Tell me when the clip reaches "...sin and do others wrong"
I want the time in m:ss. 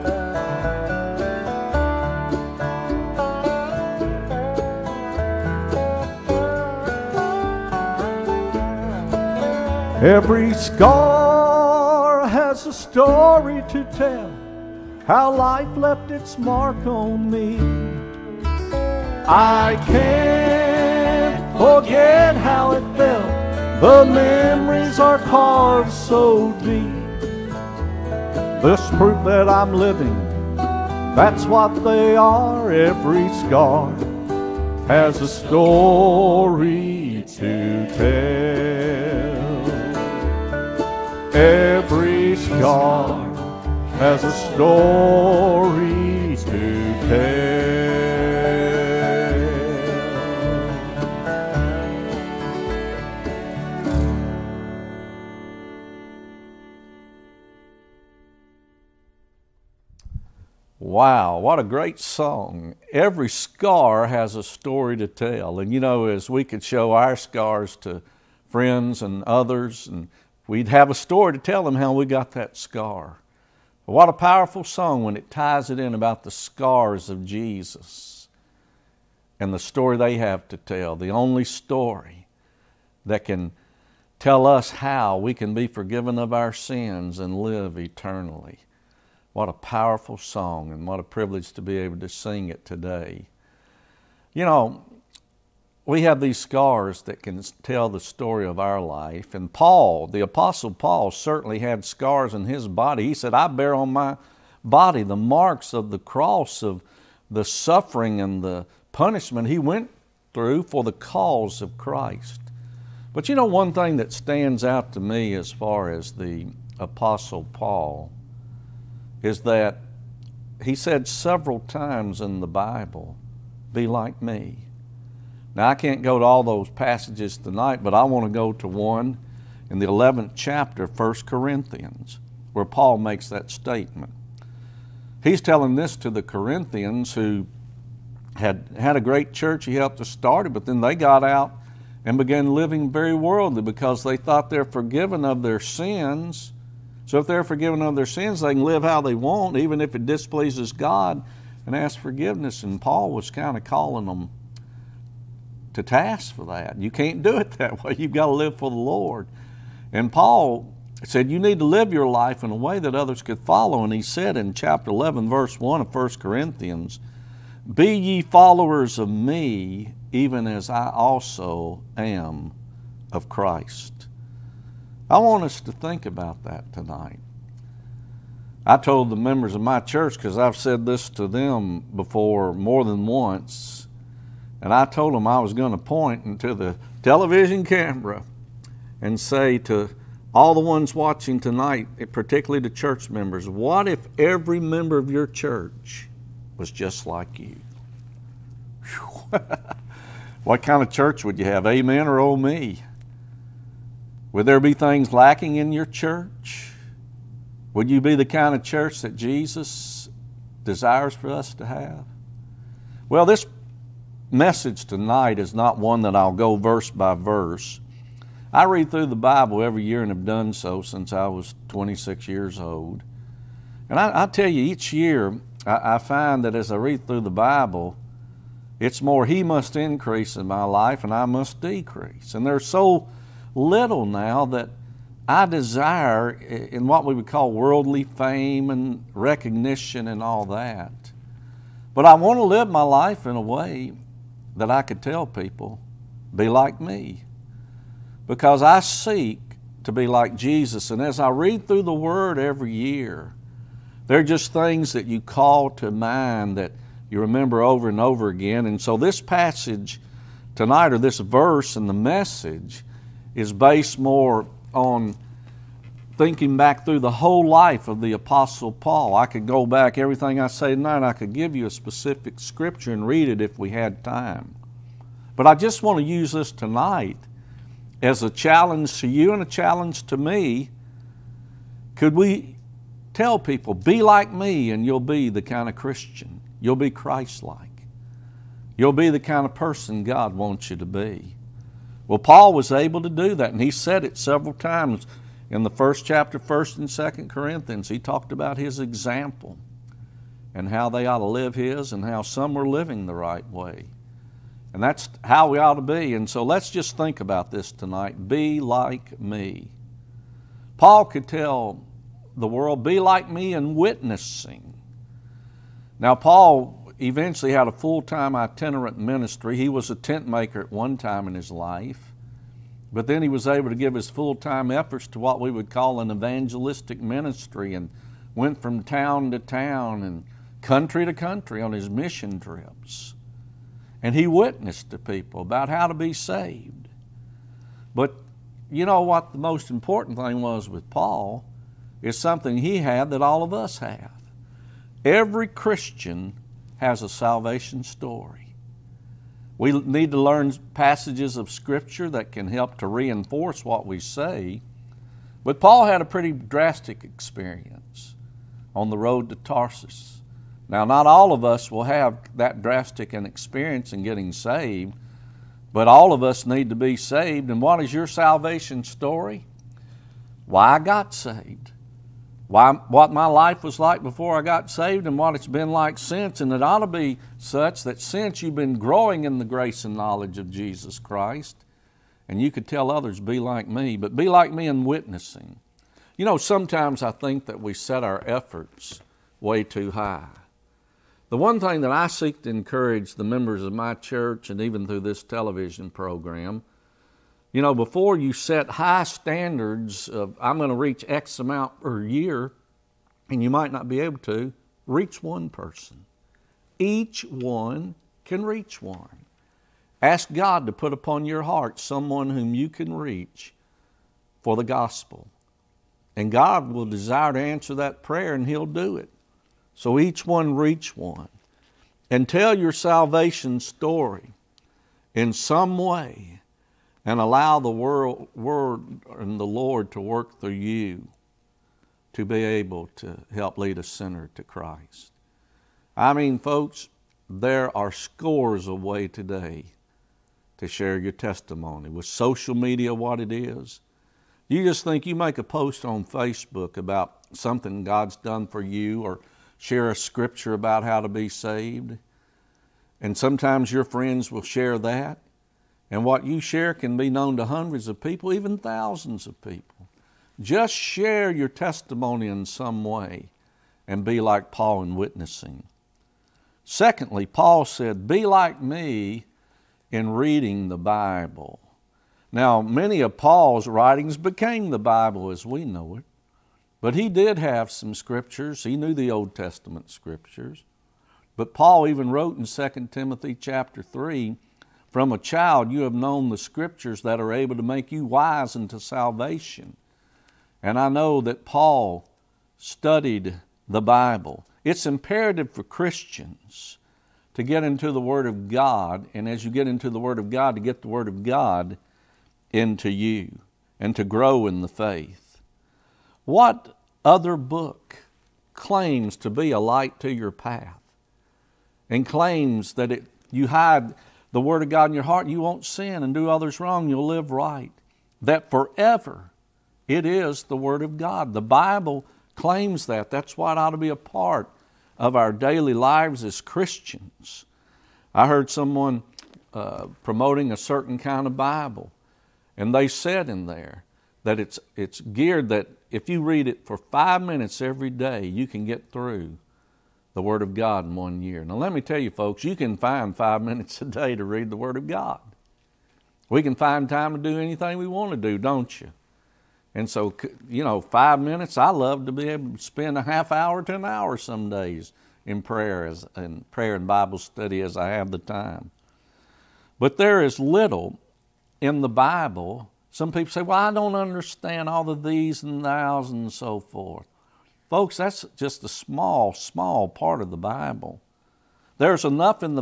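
8:35.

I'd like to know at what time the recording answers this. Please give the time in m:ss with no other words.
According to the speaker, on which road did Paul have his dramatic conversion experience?
5:58.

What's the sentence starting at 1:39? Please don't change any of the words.
And Paul, the Apostle Paul, certainly had scars in his body.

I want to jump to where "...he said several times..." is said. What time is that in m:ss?
2:00.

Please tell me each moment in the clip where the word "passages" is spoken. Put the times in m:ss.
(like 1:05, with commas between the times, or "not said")
2:06, 4:19, 5:50.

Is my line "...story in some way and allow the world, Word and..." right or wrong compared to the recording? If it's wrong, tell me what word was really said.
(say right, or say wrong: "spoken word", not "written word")
right.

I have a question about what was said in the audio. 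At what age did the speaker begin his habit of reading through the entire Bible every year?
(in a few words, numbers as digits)
26.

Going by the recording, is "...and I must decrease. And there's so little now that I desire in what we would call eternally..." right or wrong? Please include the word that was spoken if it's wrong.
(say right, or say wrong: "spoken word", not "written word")
wrong: "worldly", not "eternally".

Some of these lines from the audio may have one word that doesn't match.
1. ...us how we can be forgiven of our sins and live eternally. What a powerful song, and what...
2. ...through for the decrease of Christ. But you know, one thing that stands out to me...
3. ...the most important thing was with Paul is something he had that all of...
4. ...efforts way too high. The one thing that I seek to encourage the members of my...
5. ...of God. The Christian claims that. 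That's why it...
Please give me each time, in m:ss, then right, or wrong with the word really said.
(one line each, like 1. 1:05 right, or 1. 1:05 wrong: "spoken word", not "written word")
1. 1:24 right
2. 1:50 wrong: "cause", not "decrease"
3. 5:39 right
4. 6:28 right
5. 8:40 wrong: "Bible", not "Christian".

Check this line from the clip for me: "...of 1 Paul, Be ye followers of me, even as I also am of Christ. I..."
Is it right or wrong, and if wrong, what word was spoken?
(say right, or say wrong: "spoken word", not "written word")
wrong: "Corinthians", not "Paul".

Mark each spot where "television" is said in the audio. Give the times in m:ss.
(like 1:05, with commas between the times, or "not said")
3:07, 6:35.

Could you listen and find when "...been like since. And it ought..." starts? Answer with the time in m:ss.
6:15.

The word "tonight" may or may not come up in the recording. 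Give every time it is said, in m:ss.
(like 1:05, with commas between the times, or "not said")
2:07, 2:56, 3:11, 3:34, 4:20, 4:30, 4:36, 5:07.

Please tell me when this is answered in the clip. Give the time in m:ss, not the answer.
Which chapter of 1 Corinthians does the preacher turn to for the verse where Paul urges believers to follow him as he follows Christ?
2:09.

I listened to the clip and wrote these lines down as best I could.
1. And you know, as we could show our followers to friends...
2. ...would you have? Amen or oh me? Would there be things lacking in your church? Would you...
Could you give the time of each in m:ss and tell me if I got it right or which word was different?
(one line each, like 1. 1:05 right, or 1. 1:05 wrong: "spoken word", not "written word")
1. 1:05 wrong: "scars", not "followers"
2. 3:21 right.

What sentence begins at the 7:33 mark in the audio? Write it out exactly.
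And sometimes your friends will share that.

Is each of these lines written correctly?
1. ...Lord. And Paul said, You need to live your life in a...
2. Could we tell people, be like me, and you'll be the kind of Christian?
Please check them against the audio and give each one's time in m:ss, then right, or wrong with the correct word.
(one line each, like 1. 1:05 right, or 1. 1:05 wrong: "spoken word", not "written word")
1. 2:38 right
2. 4:41 right.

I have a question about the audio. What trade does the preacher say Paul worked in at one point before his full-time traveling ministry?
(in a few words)
Tent maker.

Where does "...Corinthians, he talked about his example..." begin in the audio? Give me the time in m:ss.
4:57.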